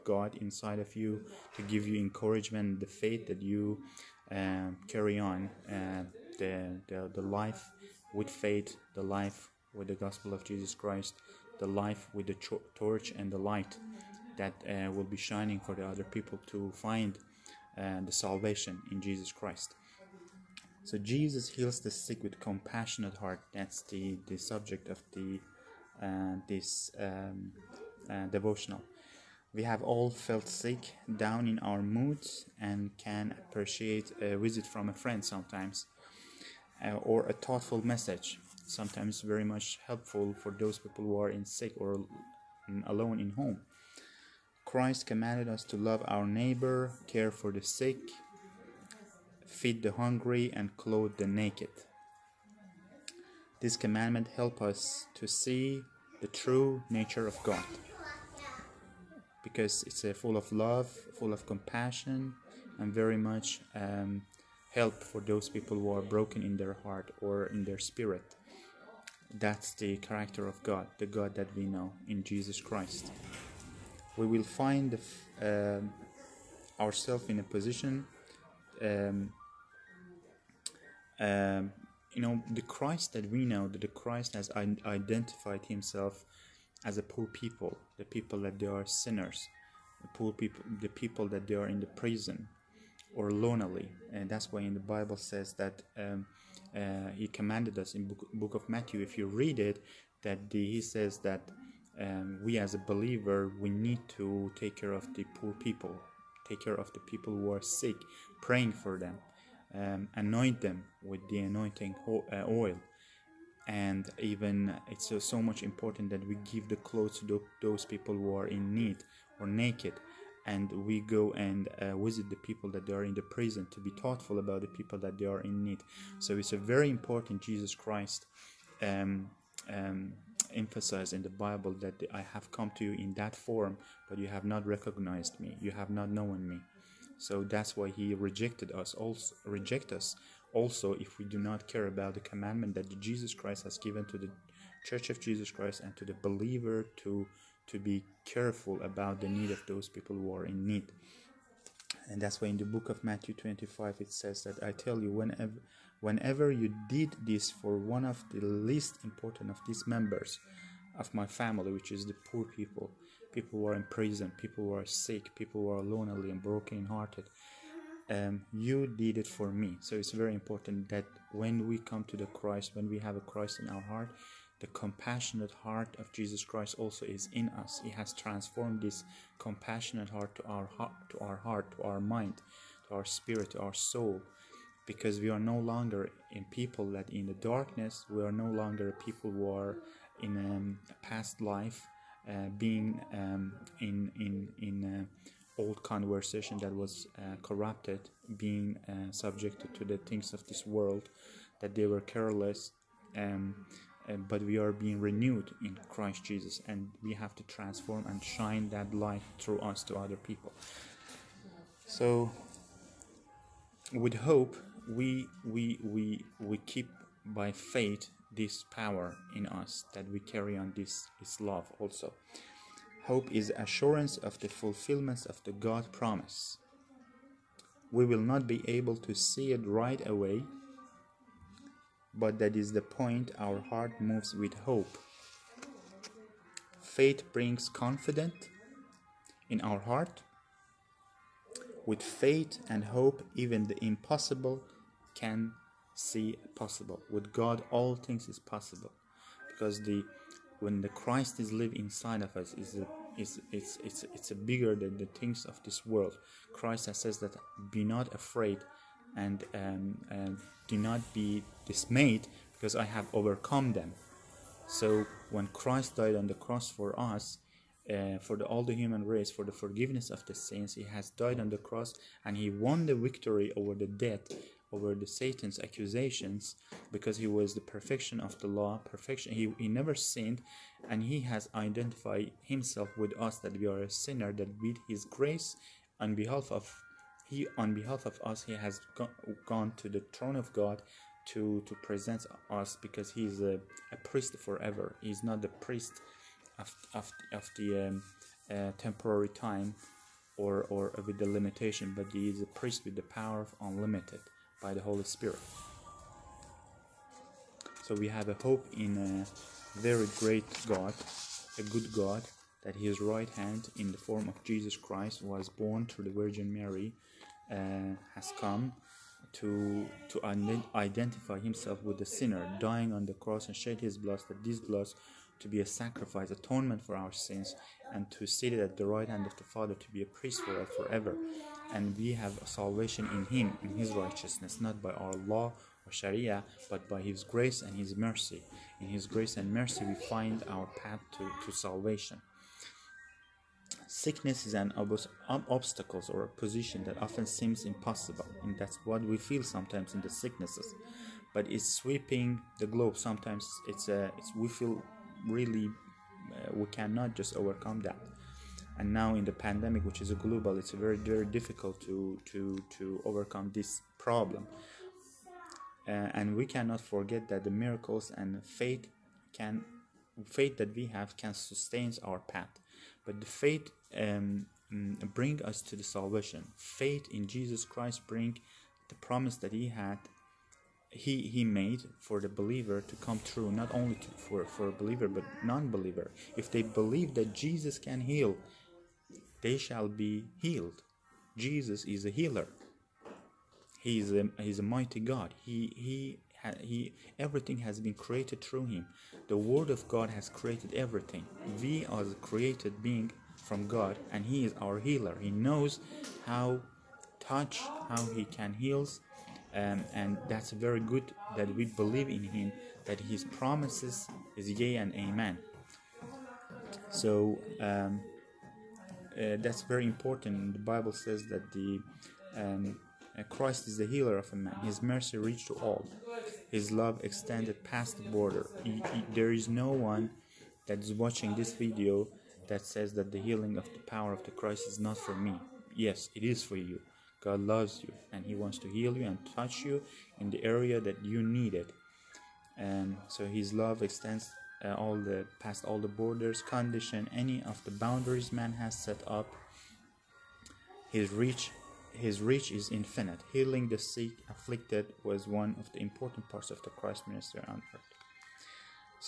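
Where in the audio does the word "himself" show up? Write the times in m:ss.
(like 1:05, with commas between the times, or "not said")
1:25, 4:42, 5:21.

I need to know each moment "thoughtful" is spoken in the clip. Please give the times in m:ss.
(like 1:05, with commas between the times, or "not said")
0:37, 2:04.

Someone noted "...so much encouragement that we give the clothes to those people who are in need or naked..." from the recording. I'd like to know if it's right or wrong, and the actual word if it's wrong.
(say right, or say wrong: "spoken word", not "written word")
wrong: "important", not "encouragement".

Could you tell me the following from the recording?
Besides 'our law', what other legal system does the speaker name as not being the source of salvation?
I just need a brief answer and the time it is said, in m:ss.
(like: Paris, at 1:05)
sharia, at 5:35.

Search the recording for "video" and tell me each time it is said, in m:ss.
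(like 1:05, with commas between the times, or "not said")
7:11.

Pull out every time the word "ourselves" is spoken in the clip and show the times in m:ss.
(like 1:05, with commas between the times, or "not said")
1:16.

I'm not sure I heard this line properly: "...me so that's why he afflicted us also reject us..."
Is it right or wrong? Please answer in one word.
wrong.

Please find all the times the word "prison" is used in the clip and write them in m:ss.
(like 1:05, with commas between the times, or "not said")
1:31, 2:03, 2:43.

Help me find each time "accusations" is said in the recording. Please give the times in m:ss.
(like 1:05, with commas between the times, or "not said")
4:35.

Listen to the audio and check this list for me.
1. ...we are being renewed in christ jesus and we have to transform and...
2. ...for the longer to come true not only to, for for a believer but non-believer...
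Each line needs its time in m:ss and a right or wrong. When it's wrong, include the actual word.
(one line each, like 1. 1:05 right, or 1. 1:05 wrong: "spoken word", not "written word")
1. 3:24 right
2. 6:21 wrong: "believer", not "longer".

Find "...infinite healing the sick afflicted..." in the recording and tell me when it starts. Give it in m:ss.
7:32.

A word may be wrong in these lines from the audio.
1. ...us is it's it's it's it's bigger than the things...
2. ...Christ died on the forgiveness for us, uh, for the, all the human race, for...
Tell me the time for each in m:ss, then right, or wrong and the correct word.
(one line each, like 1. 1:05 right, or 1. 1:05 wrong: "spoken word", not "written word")
1. 4:12 right
2. 4:25 wrong: "cross", not "forgiveness".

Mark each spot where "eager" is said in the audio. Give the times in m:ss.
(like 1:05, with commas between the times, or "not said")
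not said.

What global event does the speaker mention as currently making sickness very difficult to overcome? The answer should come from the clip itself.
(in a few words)
the pandemic.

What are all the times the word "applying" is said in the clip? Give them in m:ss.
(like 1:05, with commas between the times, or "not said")
not said.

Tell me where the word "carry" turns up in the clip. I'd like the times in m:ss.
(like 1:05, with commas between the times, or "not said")
0:04, 3:40.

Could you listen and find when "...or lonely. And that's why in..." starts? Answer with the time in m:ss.
1:33.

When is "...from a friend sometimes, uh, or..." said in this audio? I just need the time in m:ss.
0:34.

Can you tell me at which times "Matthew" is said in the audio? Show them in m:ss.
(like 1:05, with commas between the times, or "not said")
1:38, 2:33.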